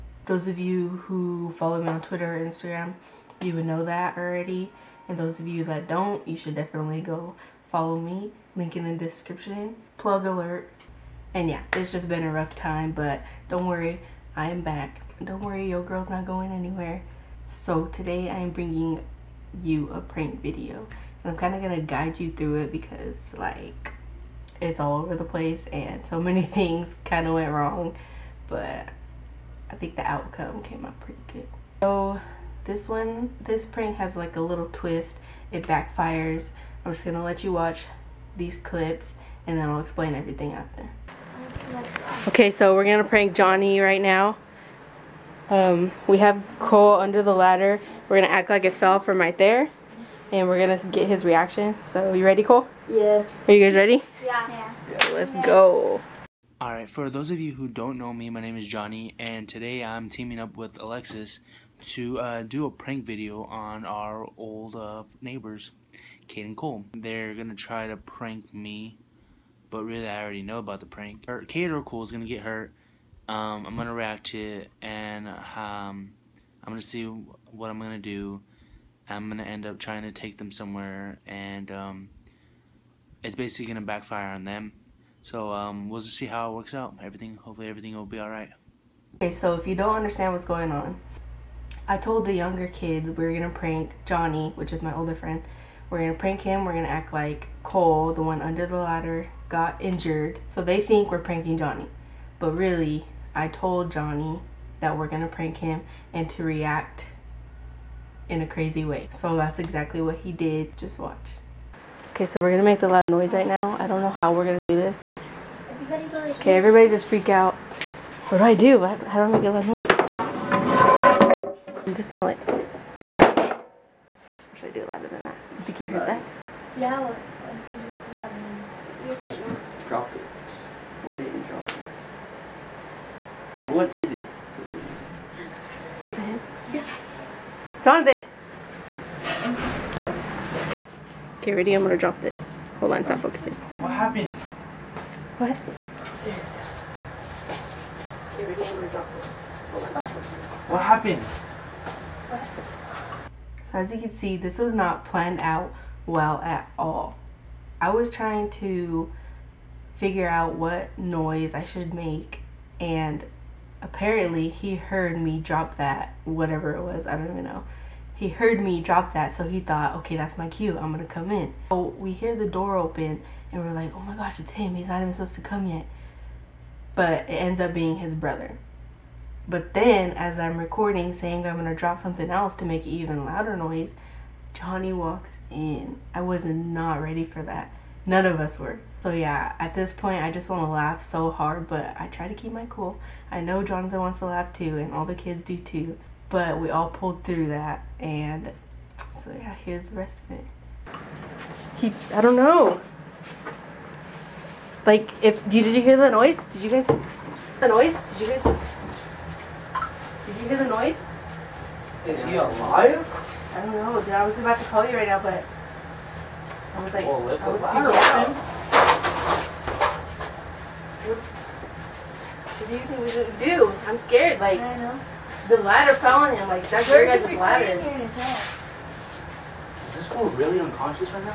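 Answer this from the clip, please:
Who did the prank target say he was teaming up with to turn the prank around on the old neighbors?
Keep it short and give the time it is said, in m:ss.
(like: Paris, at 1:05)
Alexis, at 1:00.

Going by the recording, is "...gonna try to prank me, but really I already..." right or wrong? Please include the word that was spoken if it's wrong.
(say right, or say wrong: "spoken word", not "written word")
right.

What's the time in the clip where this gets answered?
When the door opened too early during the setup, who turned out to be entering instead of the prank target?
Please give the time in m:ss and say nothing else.
2:57.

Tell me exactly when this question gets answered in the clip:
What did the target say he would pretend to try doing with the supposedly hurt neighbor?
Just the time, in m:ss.
1:20.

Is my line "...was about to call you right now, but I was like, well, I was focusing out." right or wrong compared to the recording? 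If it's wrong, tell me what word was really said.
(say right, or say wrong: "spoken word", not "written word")
wrong: "freaking", not "focusing".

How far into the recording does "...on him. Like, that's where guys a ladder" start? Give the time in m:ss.
3:46.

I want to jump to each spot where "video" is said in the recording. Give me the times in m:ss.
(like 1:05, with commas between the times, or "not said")
0:20, 1:03.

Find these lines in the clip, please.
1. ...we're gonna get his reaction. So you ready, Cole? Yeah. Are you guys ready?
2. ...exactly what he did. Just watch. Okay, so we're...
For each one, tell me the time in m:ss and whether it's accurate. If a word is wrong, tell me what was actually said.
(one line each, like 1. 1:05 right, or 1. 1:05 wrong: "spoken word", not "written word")
1. 0:50 right
2. 1:49 right.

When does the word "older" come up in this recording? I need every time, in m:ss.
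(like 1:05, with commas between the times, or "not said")
1:34.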